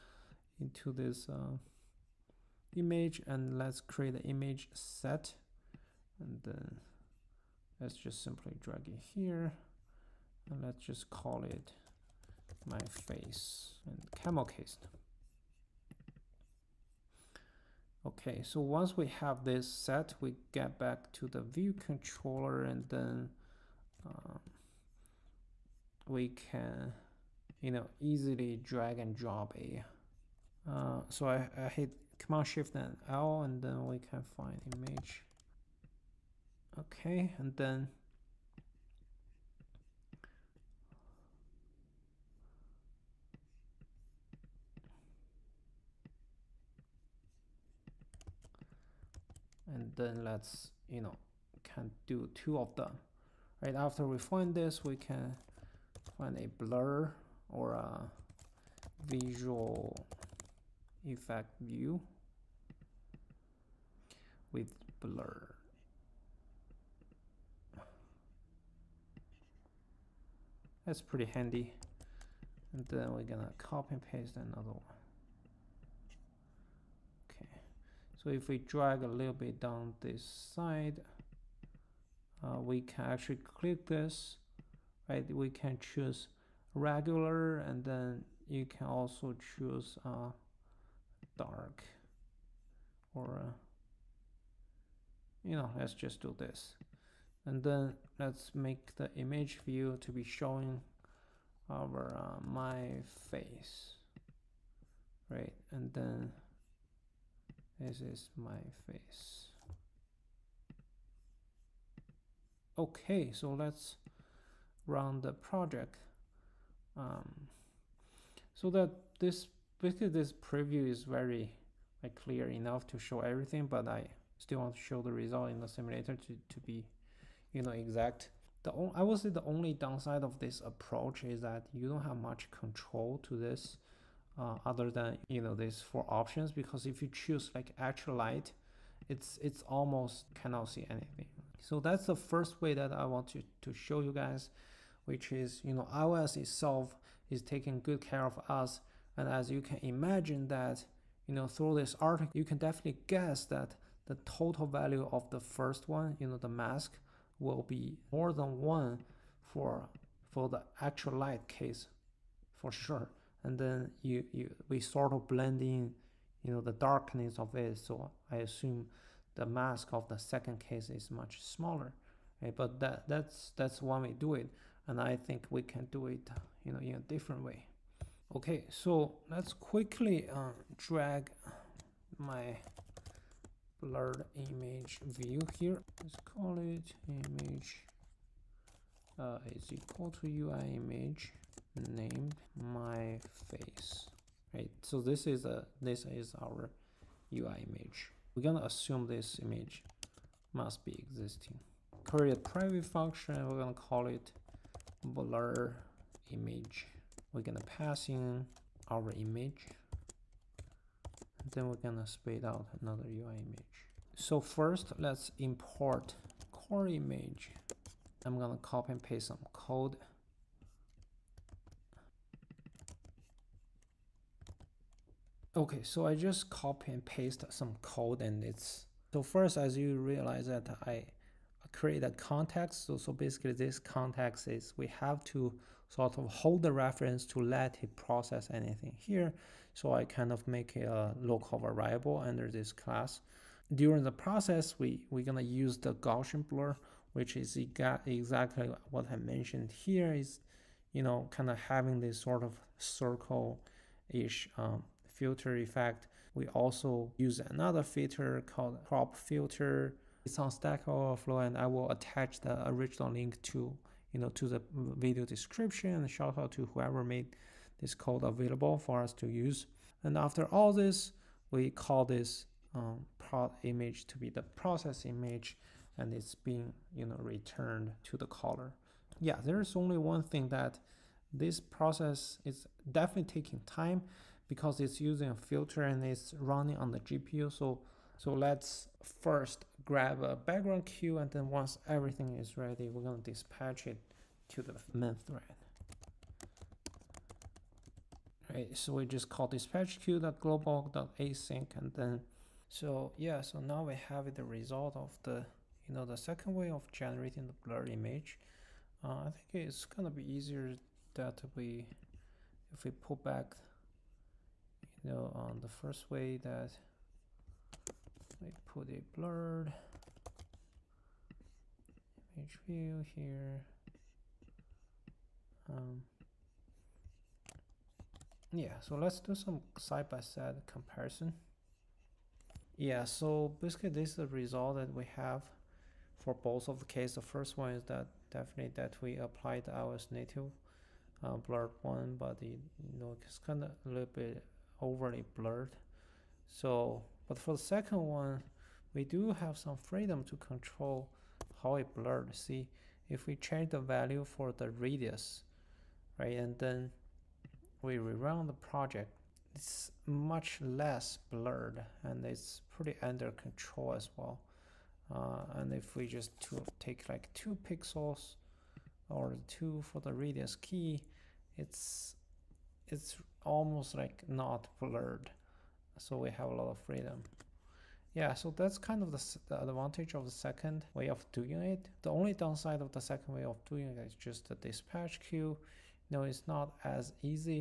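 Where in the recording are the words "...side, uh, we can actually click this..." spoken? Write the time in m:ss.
1:20.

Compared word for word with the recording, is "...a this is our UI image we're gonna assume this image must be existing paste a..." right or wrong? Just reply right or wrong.
wrong.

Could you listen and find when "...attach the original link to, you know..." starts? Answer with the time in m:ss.
4:21.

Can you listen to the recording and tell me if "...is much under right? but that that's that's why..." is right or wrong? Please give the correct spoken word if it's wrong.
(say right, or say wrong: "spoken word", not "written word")
wrong: "smaller", not "under".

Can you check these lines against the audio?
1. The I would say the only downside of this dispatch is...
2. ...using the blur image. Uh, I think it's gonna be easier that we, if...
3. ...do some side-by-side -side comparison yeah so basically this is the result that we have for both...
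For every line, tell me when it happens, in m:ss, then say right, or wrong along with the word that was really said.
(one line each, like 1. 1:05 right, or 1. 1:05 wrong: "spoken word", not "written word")
1. 2:08 wrong: "approach", not "dispatch"
2. 5:06 wrong: "generating", not "using"
3. 5:29 right.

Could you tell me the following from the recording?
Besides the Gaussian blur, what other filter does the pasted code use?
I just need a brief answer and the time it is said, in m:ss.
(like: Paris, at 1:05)
crop filter, at 4:18.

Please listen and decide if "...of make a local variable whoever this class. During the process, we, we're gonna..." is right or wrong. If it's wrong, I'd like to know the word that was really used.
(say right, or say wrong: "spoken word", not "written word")
wrong: "under", not "whoever".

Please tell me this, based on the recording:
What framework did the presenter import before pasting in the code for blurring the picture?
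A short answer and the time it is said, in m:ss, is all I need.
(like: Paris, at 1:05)
Core Image, at 3:36.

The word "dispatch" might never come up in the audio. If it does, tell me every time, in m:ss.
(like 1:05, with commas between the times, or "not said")
4:53, 4:59, 6:24.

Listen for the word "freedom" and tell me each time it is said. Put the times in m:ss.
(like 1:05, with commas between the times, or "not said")
5:49, 6:16.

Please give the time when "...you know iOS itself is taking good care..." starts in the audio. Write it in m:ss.
2:25.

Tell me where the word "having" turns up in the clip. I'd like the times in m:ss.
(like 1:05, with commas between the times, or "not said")
4:11.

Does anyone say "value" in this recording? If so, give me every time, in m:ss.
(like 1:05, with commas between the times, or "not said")
2:34, 5:53.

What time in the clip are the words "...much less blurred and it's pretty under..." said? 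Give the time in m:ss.
6:00.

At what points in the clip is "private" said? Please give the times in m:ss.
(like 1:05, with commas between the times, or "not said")
3:22.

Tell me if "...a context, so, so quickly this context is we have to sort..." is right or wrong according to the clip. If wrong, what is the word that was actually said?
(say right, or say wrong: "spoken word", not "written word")
wrong: "basically", not "quickly".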